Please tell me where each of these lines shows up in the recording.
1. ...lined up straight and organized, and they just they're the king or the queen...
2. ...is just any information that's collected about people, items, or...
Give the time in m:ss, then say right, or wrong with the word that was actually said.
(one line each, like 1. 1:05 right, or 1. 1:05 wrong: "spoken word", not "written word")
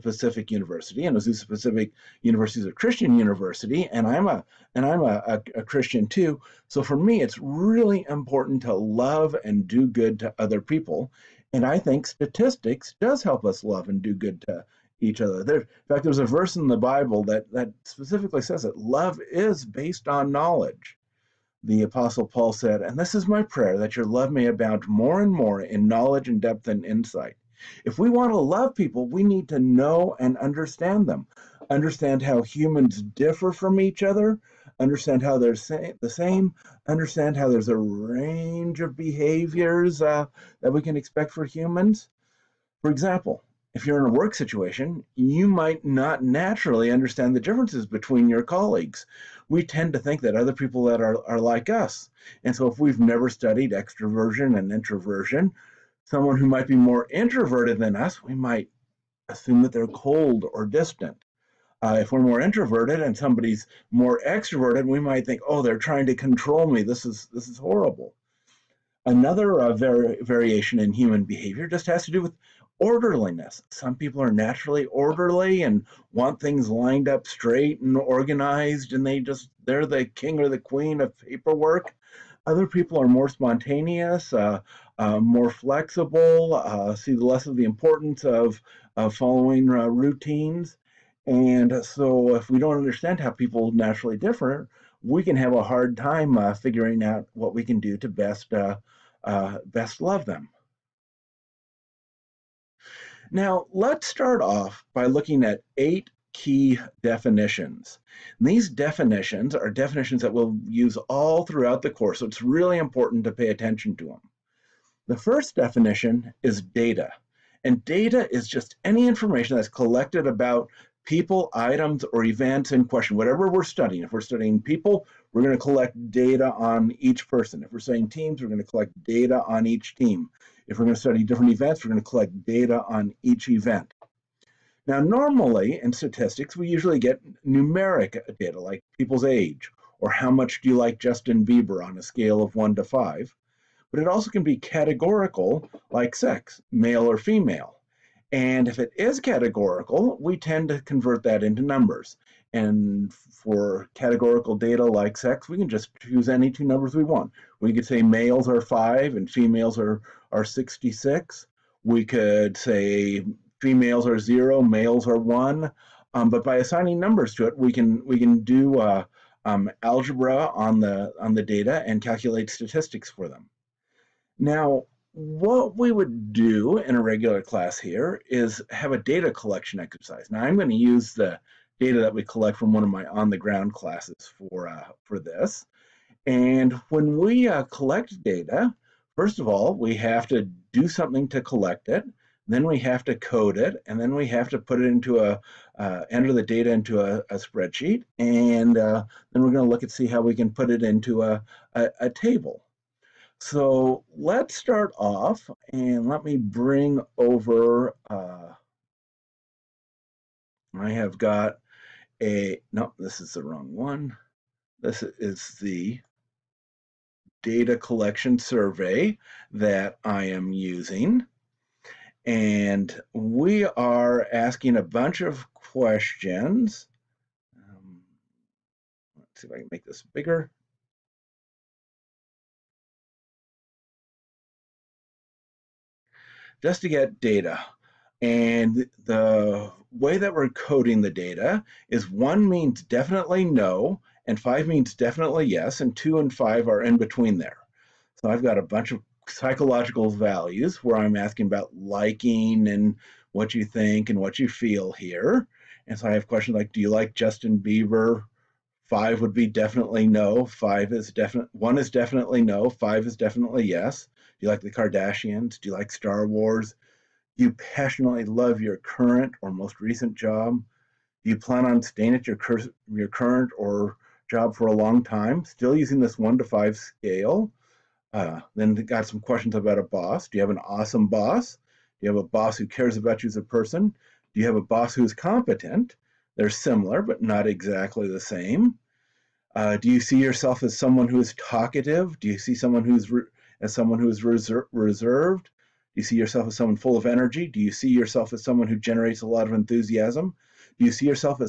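1. 1:16 right
2. 1:58 right.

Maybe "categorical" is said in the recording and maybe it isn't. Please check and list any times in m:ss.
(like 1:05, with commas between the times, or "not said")
2:24, 2:29, 2:33.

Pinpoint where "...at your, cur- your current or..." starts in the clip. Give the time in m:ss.
4:32.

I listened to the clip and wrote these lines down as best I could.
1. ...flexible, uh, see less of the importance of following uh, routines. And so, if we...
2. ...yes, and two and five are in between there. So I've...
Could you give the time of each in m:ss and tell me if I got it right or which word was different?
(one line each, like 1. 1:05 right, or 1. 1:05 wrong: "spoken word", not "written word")
1. 1:25 right
2. 4:05 right.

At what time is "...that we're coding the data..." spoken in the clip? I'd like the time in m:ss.
4:00.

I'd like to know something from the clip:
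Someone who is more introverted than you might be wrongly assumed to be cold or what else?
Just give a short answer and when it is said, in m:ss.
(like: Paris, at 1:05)
distant, at 1:00.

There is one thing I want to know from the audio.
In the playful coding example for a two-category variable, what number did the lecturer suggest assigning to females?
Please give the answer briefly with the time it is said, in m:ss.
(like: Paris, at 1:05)
66, at 2:40.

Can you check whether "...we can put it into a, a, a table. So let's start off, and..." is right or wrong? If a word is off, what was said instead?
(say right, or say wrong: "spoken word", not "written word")
right.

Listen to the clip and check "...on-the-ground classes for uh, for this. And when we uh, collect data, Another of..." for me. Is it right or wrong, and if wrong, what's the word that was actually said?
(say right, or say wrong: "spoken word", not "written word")
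wrong: "First", not "Another".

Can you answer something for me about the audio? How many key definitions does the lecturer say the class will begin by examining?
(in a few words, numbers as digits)
8.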